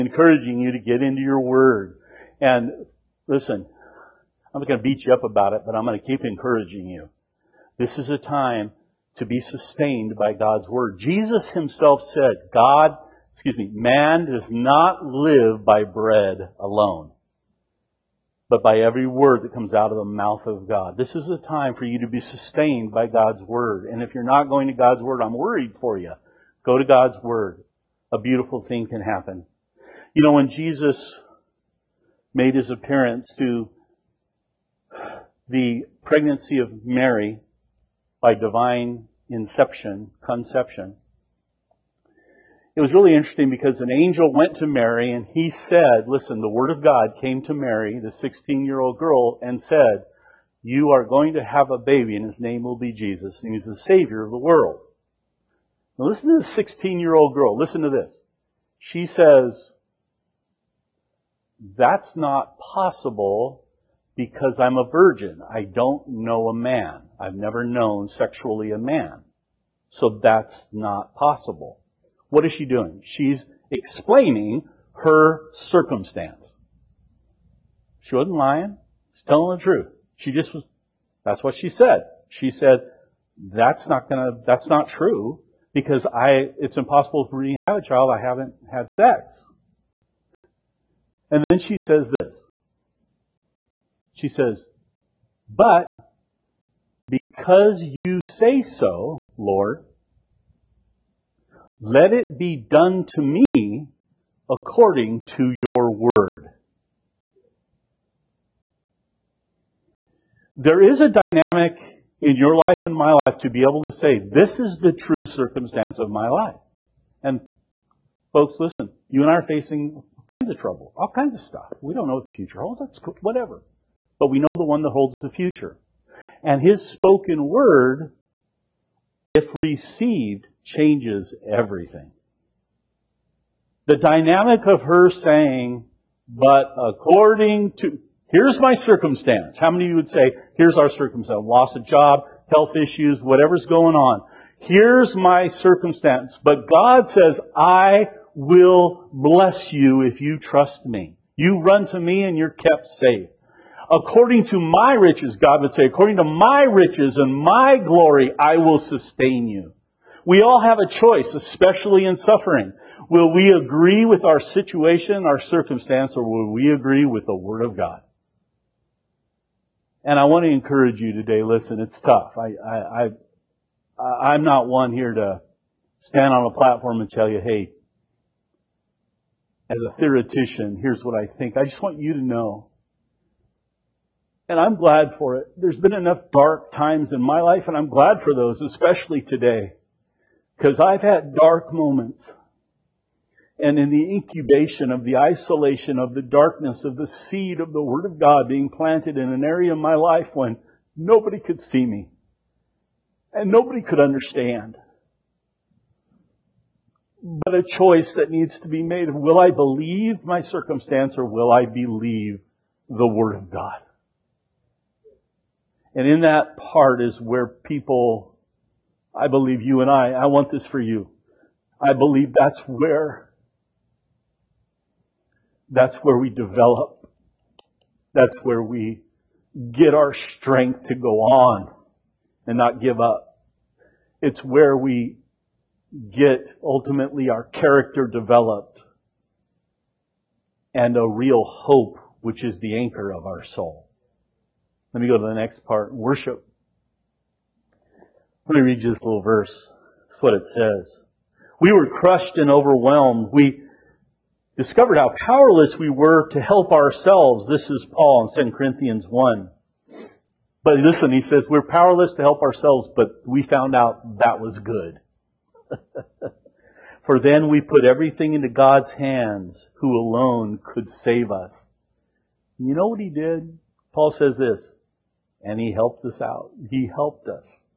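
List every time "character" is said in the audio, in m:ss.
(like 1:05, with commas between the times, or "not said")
3:57.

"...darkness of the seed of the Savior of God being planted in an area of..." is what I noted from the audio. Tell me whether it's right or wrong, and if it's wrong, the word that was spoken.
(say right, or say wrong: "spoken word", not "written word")
wrong: "Word", not "Savior".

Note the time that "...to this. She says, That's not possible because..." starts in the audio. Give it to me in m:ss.
0:57.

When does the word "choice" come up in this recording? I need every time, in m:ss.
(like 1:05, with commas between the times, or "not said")
2:40, 3:27.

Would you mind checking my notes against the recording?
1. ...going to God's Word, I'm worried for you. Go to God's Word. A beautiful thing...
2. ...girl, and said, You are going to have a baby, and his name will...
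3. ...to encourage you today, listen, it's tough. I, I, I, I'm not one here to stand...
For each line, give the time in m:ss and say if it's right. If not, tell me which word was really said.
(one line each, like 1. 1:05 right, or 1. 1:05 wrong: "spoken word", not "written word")
1. 0:24 right
2. 0:48 right
3. 2:50 right.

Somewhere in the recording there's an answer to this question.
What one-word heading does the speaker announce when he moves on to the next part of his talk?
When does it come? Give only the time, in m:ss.
4:05.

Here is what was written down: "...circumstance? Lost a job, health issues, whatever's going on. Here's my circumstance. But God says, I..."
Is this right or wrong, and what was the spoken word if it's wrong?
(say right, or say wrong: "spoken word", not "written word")
right.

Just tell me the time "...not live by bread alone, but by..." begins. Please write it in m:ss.
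0:14.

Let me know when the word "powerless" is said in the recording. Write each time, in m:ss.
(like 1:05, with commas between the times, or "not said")
4:15, 4:21.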